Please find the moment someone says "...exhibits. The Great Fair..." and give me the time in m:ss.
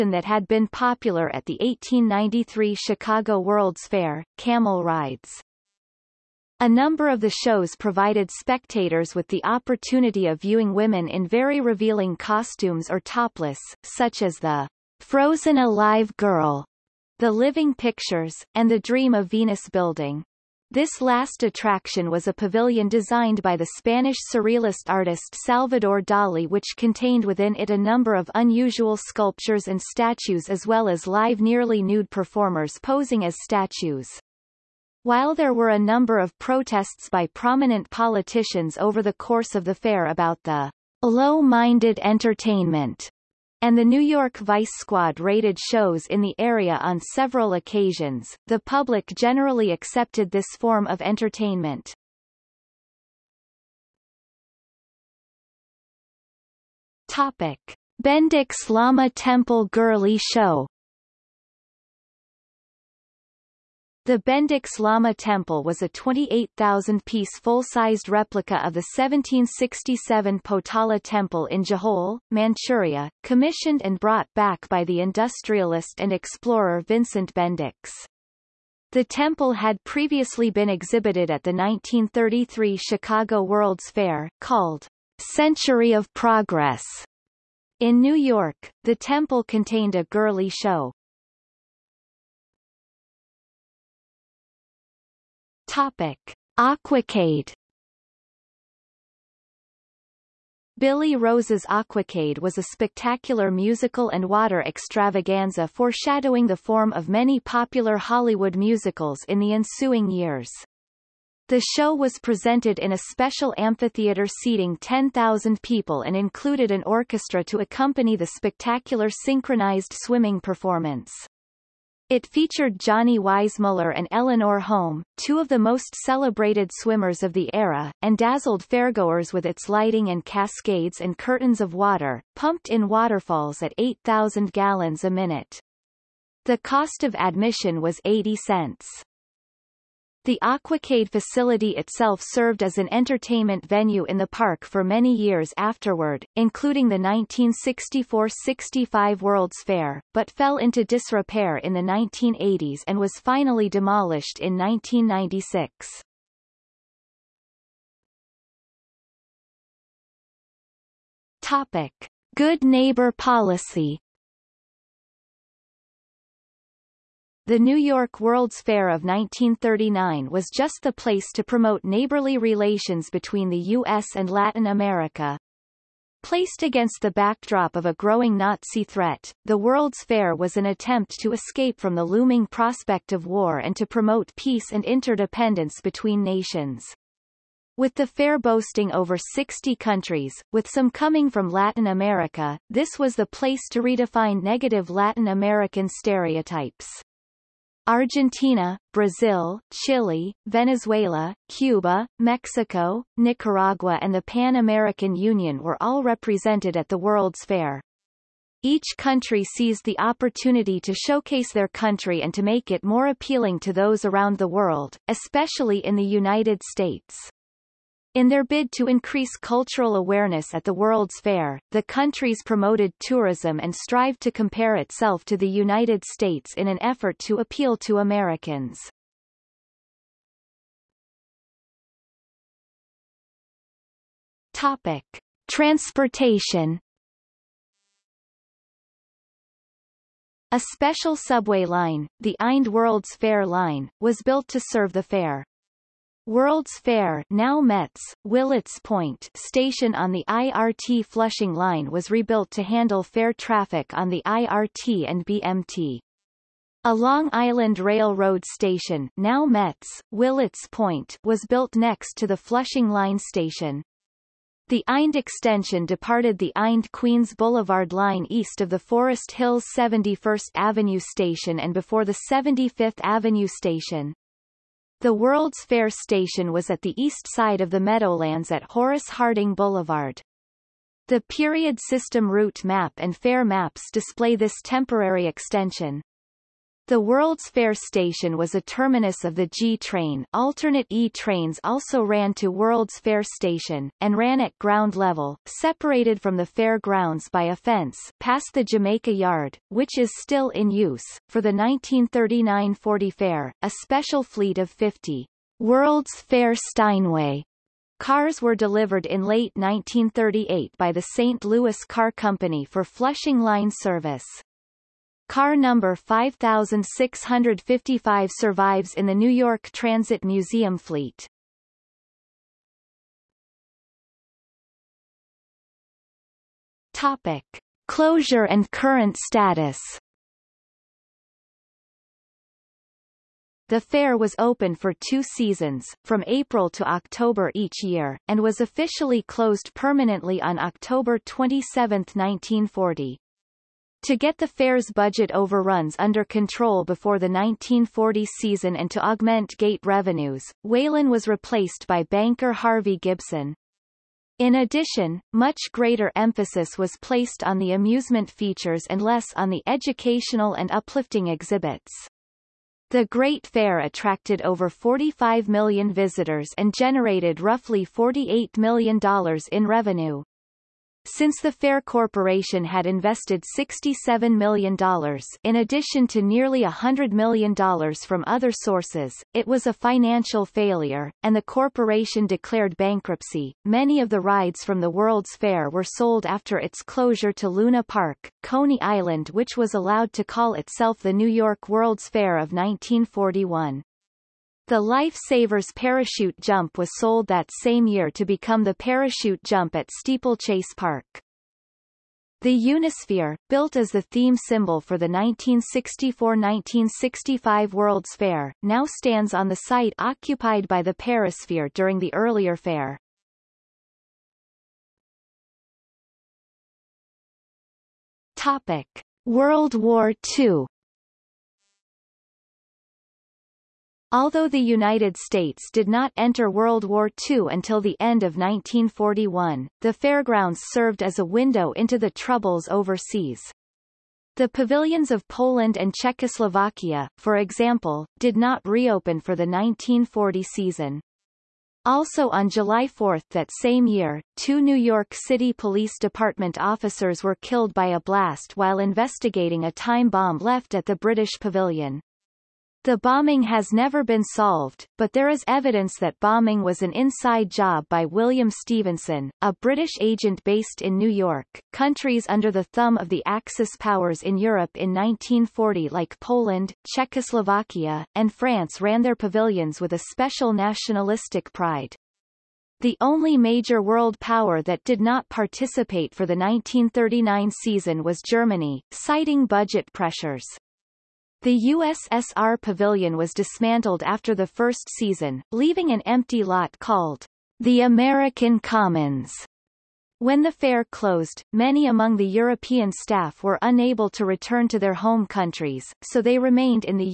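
6:01.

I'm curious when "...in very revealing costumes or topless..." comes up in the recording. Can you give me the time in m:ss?
0:11.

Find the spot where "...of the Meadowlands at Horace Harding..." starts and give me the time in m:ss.
4:37.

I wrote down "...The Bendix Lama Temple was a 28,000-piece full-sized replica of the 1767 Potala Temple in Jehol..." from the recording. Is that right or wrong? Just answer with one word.
right.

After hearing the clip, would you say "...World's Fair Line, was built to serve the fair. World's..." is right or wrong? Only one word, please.
right.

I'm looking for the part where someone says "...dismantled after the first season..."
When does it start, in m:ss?
8:03.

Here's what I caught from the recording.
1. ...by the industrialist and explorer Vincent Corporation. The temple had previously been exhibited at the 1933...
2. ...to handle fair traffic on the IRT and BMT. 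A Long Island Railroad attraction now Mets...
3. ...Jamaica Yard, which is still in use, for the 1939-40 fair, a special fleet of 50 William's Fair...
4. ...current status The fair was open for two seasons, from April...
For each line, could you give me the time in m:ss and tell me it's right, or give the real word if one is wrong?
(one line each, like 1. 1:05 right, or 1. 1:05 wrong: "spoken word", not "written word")
1. 1:14 wrong: "Bendix", not "Corporation"
2. 4:12 wrong: "station", not "attraction"
3. 4:58 wrong: "World", not "William"
4. 5:28 right.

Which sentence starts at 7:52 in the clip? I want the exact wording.
The only major world power that did not participate for the 1939 season was Germany, citing budget pressures.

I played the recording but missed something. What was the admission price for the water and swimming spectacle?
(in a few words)
80 cents.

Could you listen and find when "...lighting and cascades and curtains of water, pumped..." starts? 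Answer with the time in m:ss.
2:09.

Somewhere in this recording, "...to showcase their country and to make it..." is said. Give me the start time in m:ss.
3:30.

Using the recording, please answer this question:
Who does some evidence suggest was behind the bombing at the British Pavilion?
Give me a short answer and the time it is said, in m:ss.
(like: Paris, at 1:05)
William Stephenson, at 7:38.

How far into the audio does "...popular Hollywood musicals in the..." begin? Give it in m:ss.
1:47.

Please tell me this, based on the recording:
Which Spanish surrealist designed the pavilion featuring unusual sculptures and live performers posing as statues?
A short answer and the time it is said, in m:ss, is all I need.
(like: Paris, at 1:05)
Salvador Dali, at 0:25.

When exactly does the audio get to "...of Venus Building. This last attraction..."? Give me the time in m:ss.
0:19.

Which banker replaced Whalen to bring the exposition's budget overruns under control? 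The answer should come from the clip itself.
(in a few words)
Harvey Gibson.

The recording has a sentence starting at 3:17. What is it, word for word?
Argentina, Brazil, Chile, Venezuela, Cuba, Mexico, Nicaragua and the Pan American Union were all represented at the World's Fair.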